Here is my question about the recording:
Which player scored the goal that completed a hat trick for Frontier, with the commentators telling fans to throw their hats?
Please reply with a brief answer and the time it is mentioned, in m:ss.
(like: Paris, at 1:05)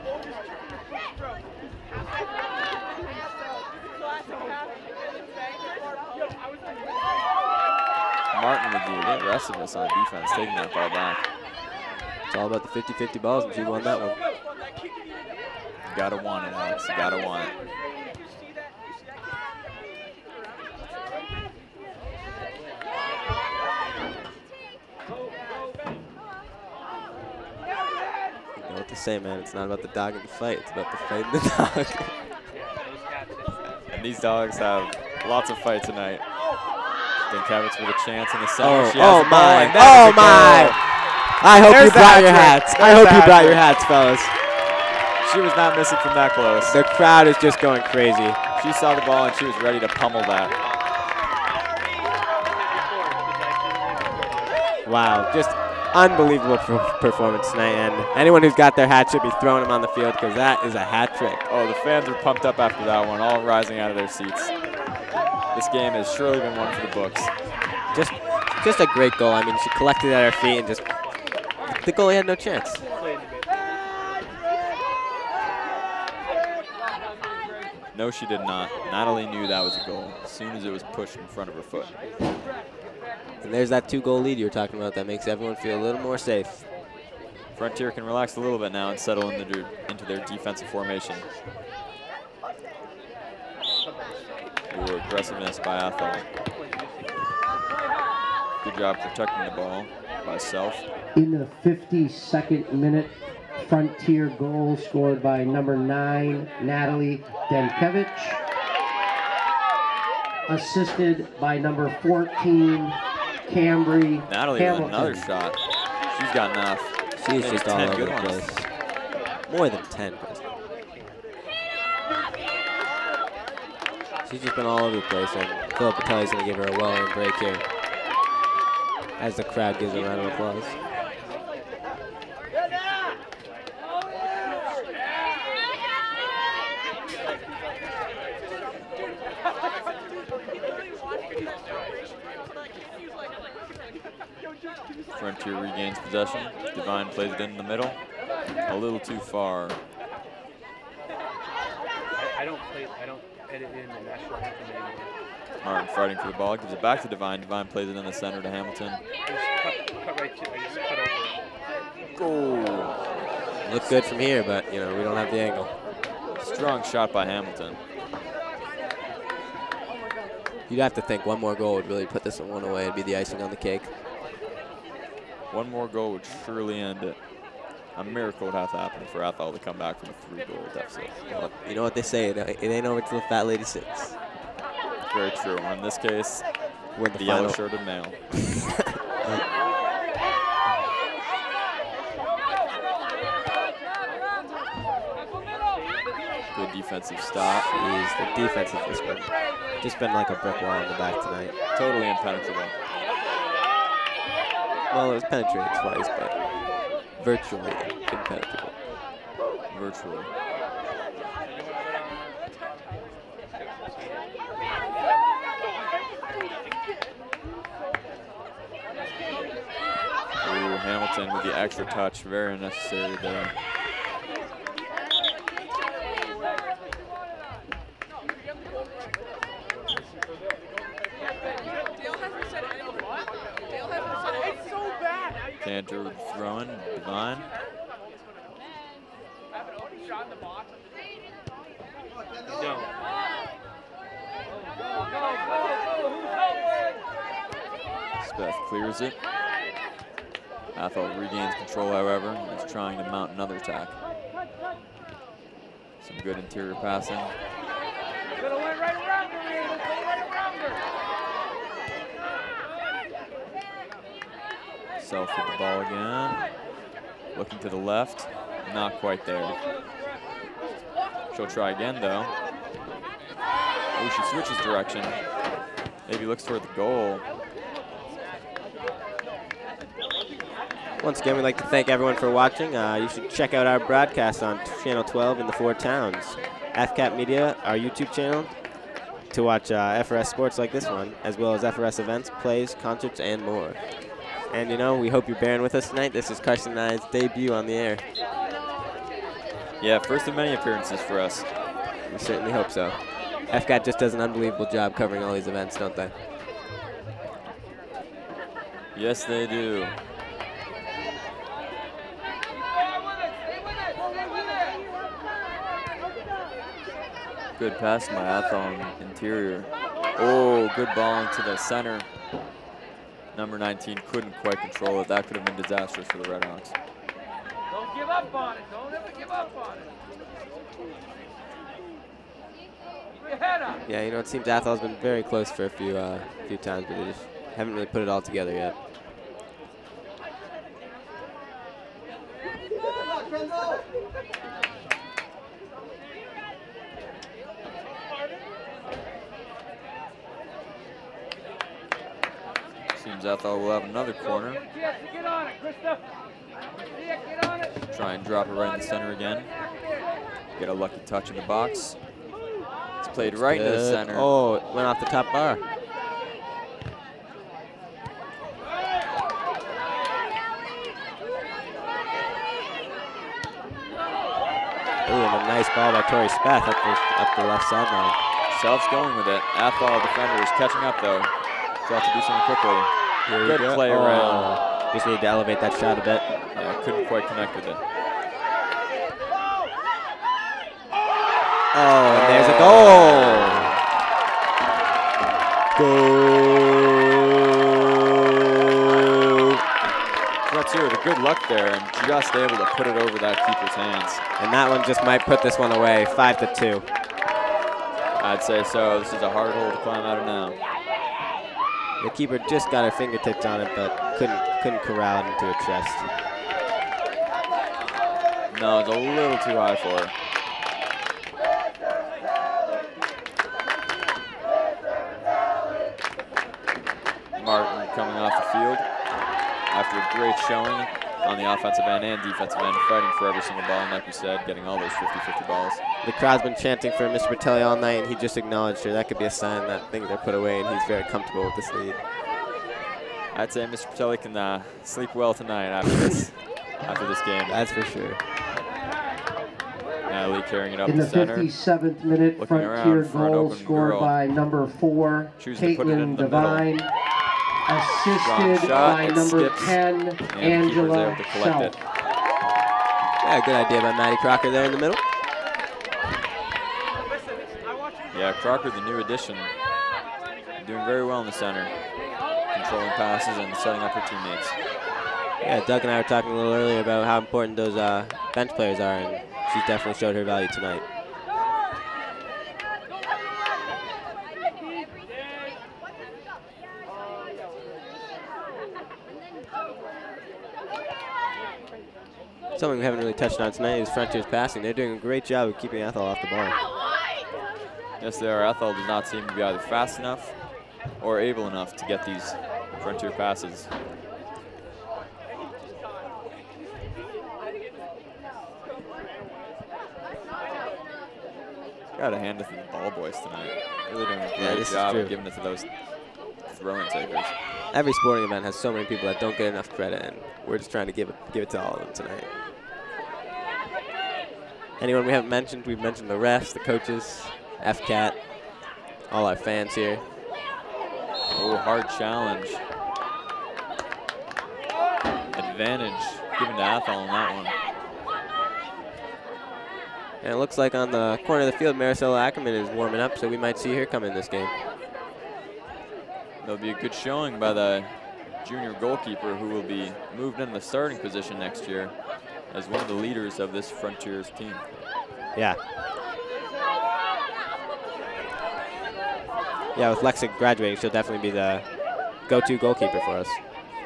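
Natalie Denkevitz, at 1:46.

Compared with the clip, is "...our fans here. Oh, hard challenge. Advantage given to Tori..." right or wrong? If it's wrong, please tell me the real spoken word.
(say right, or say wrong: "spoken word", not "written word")
wrong: "Athol", not "Tori".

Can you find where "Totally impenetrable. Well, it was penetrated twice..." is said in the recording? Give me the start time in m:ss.
3:21.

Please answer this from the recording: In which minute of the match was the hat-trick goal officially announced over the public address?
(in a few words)
52nd.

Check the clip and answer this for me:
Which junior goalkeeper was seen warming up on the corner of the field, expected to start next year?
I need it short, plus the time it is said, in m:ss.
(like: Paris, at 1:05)
Marisol Ackerman, at 9:01.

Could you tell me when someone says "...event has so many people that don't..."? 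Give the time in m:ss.
8:38.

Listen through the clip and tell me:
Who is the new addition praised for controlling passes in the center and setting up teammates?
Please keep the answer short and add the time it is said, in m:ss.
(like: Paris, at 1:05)
Maddie Crocker, at 7:43.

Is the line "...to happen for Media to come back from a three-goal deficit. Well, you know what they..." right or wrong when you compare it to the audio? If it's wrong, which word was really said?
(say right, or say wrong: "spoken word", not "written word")
wrong: "Athol", not "Media".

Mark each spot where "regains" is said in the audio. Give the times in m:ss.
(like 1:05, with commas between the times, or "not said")
2:25, 4:11.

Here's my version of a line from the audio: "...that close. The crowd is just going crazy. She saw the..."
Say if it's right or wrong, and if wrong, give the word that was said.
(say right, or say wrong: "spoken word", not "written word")
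right.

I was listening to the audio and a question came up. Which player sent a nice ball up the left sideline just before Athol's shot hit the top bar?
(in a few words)
Tori Speth.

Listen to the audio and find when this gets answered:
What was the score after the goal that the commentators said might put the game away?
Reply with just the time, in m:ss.
6:46.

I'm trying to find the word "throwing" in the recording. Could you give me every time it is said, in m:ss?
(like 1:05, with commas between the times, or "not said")
0:59, 3:56, 8:36.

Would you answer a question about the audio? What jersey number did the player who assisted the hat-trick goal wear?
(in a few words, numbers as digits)
14.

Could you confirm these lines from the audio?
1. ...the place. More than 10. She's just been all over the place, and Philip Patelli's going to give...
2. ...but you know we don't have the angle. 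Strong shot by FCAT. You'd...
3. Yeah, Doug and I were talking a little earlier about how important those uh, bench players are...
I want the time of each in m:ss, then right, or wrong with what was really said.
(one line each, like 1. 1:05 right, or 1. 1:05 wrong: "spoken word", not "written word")
1. 1:58 right
2. 2:44 wrong: "Hamilton", not "FCAT"
3. 7:55 right.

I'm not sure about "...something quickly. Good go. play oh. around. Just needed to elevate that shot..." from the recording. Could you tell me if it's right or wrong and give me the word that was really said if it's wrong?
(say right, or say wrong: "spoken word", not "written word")
right.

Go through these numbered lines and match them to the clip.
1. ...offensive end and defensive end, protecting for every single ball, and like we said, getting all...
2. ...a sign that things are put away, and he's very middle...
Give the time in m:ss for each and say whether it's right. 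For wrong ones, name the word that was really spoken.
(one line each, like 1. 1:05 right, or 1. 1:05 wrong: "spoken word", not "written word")
1. 7:11 wrong: "fighting", not "protecting"
2. 7:19 wrong: "comfortable", not "middle".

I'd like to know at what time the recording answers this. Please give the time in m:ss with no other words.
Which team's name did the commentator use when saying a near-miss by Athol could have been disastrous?
5:26.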